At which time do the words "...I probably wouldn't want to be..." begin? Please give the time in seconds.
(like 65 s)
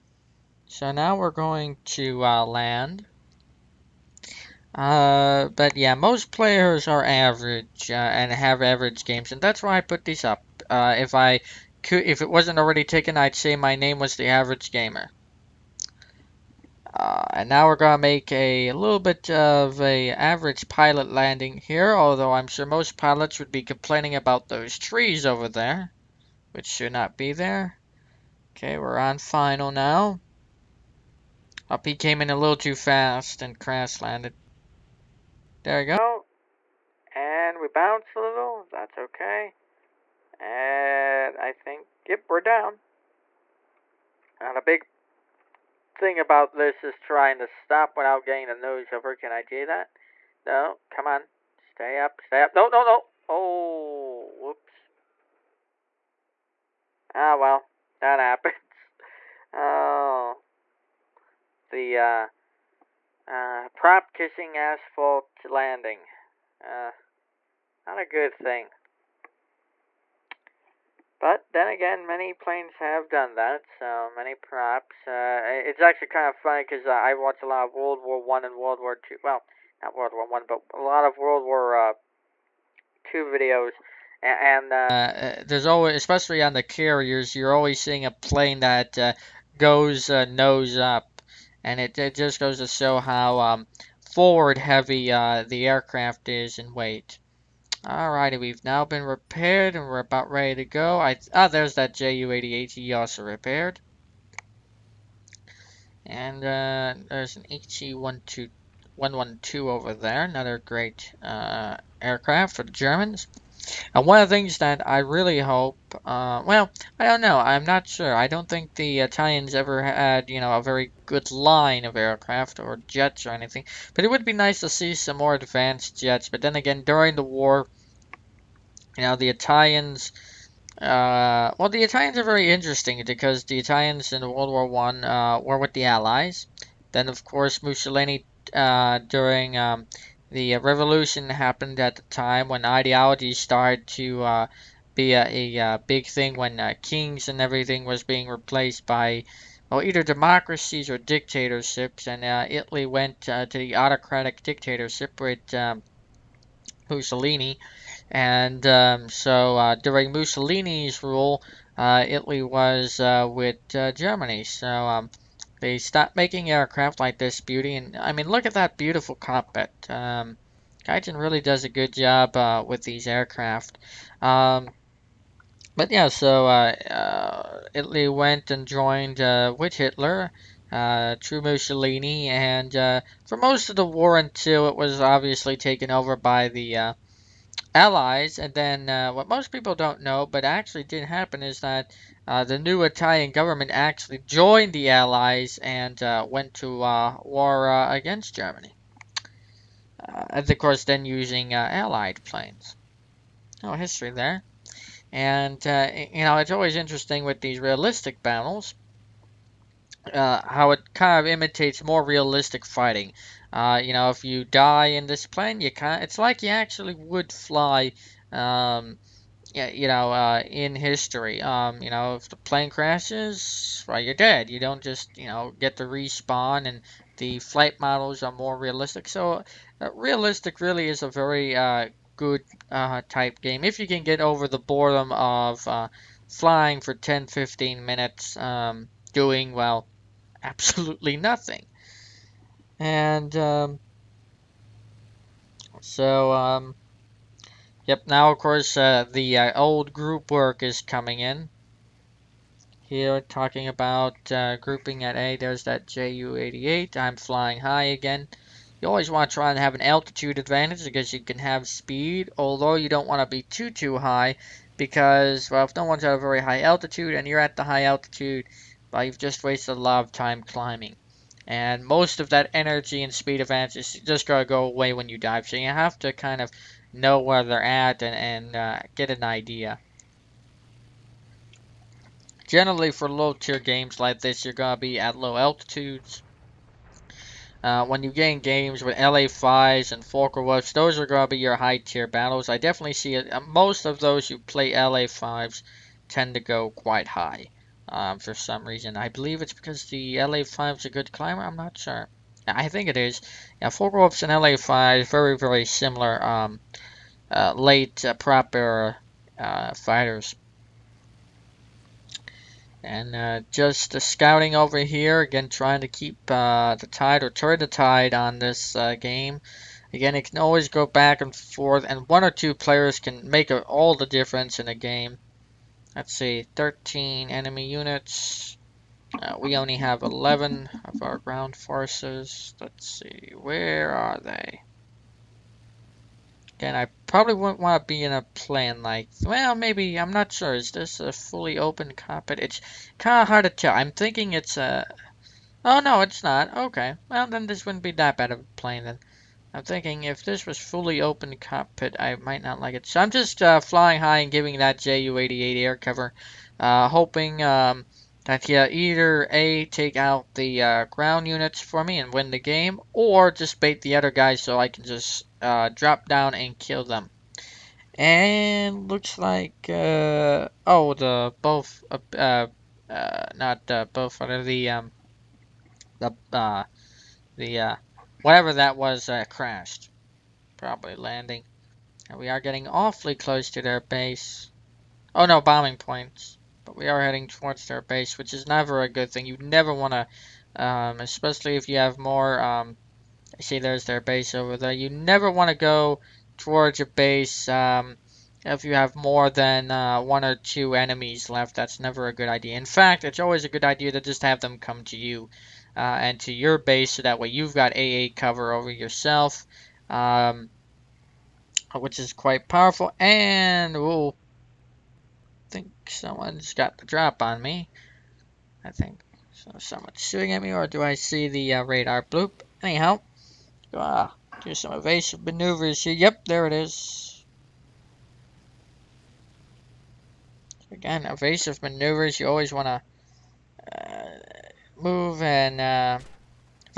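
336 s.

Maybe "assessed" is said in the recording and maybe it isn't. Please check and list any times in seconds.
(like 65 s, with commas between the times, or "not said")
not said.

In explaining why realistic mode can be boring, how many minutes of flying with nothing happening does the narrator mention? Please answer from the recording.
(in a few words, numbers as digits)
10 to 15 minutes.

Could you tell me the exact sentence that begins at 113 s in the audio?
And one of the things that I really hope, uh, well, I don't know, I'm not sure.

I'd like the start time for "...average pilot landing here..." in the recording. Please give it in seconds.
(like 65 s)
20 s.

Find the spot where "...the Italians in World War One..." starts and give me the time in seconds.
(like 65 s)
133 s.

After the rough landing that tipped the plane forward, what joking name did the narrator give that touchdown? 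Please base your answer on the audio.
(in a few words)
prop kissing asphalt landing.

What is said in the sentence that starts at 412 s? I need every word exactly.
And, oh, I think someone's got the drop on me.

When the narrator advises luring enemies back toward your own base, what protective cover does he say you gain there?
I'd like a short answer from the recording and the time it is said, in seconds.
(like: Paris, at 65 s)
AA cover, at 407 s.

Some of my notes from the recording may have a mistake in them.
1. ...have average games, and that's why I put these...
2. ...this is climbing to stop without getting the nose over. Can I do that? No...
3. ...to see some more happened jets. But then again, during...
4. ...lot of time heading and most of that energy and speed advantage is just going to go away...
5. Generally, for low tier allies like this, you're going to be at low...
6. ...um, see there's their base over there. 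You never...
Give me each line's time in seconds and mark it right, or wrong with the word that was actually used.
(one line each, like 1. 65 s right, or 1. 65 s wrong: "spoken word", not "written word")
1. 8 s right
2. 46 s wrong: "trying", not "climbing"
3. 124 s wrong: "advanced", not "happened"
4. 269 s wrong: "climbing", not "heading"
5. 282 s wrong: "games", not "allies"
6. 392 s right.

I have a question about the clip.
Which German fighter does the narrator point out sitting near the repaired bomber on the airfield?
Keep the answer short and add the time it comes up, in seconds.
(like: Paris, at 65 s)
HE-112, at 107 s.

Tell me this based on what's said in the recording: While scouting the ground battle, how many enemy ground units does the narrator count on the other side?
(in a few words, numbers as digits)
13.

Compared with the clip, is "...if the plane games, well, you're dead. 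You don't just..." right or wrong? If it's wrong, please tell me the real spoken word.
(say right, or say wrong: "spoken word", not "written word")
wrong: "crashes", not "games".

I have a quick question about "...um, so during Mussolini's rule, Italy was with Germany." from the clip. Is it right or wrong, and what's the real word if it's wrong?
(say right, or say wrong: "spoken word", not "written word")
right.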